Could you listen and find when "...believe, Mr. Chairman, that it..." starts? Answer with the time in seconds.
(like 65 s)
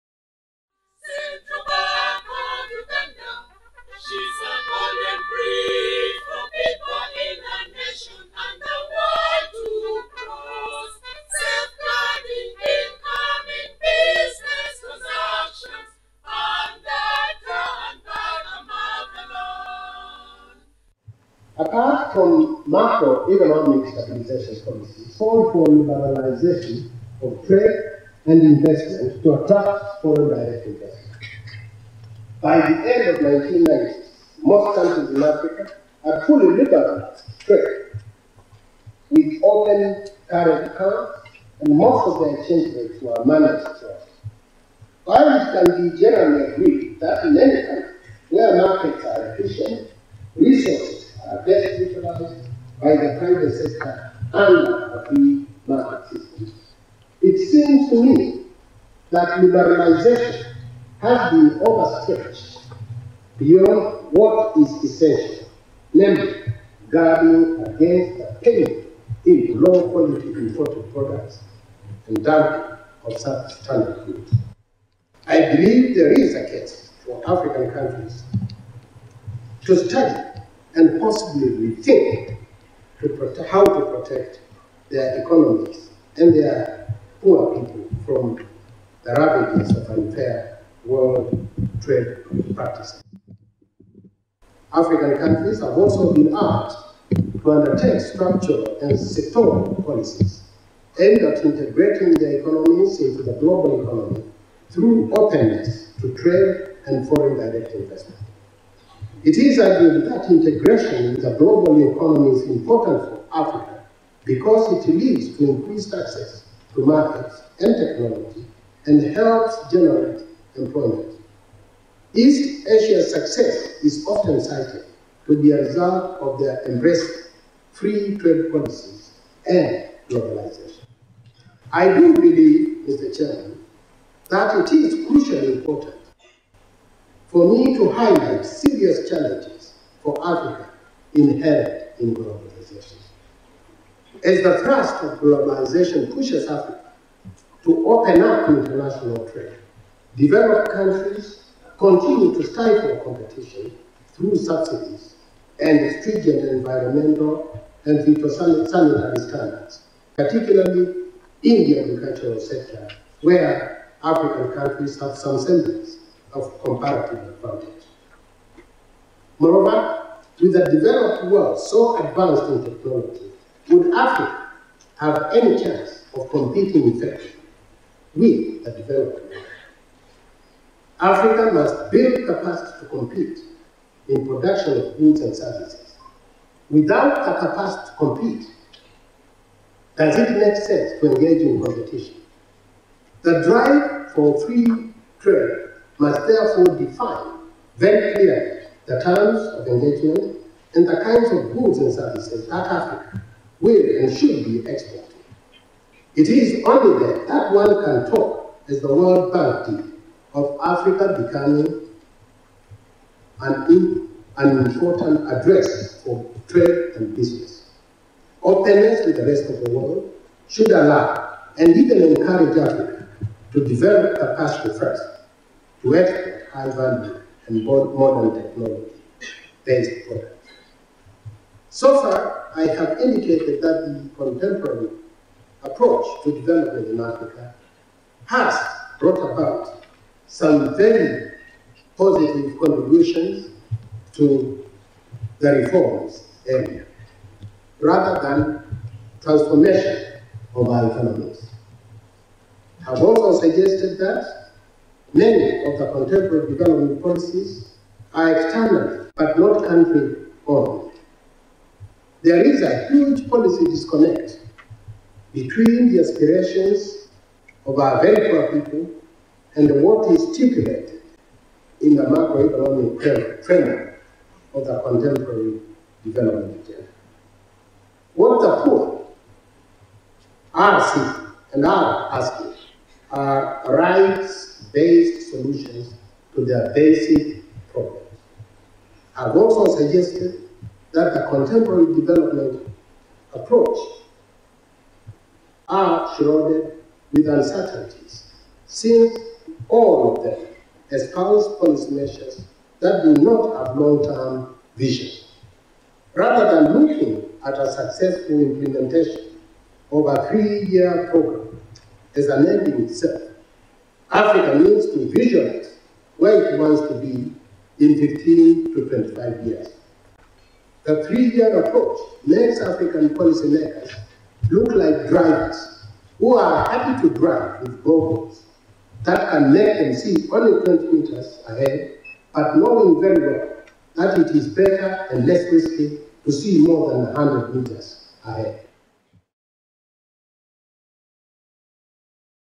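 132 s.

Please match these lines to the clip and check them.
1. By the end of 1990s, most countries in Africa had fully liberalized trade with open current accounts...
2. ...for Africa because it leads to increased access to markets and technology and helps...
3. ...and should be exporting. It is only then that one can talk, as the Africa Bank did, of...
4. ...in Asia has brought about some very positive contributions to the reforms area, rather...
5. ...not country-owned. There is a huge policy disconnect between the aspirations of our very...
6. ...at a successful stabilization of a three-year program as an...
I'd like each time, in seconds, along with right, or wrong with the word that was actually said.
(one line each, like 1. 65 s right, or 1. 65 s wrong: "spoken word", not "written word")
1. 32 s right
2. 113 s right
3. 203 s wrong: "World", not "Africa"
4. 236 s wrong: "Africa", not "Asia"
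5. 259 s right
6. 307 s wrong: "implementation", not "stabilization".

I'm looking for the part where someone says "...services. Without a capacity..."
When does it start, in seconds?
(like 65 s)
185 s.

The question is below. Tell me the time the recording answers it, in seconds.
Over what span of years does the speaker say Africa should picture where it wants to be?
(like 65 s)
317 s.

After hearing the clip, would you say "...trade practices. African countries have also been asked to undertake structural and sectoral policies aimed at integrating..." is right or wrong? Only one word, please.
right.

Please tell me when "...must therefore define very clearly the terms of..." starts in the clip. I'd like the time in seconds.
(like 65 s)
196 s.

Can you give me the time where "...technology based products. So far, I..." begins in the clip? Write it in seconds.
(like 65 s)
228 s.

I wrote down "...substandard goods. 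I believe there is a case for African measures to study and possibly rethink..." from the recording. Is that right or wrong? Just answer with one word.
wrong.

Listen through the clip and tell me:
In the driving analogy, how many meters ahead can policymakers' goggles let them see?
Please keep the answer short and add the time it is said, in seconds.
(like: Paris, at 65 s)
20 meters, at 330 s.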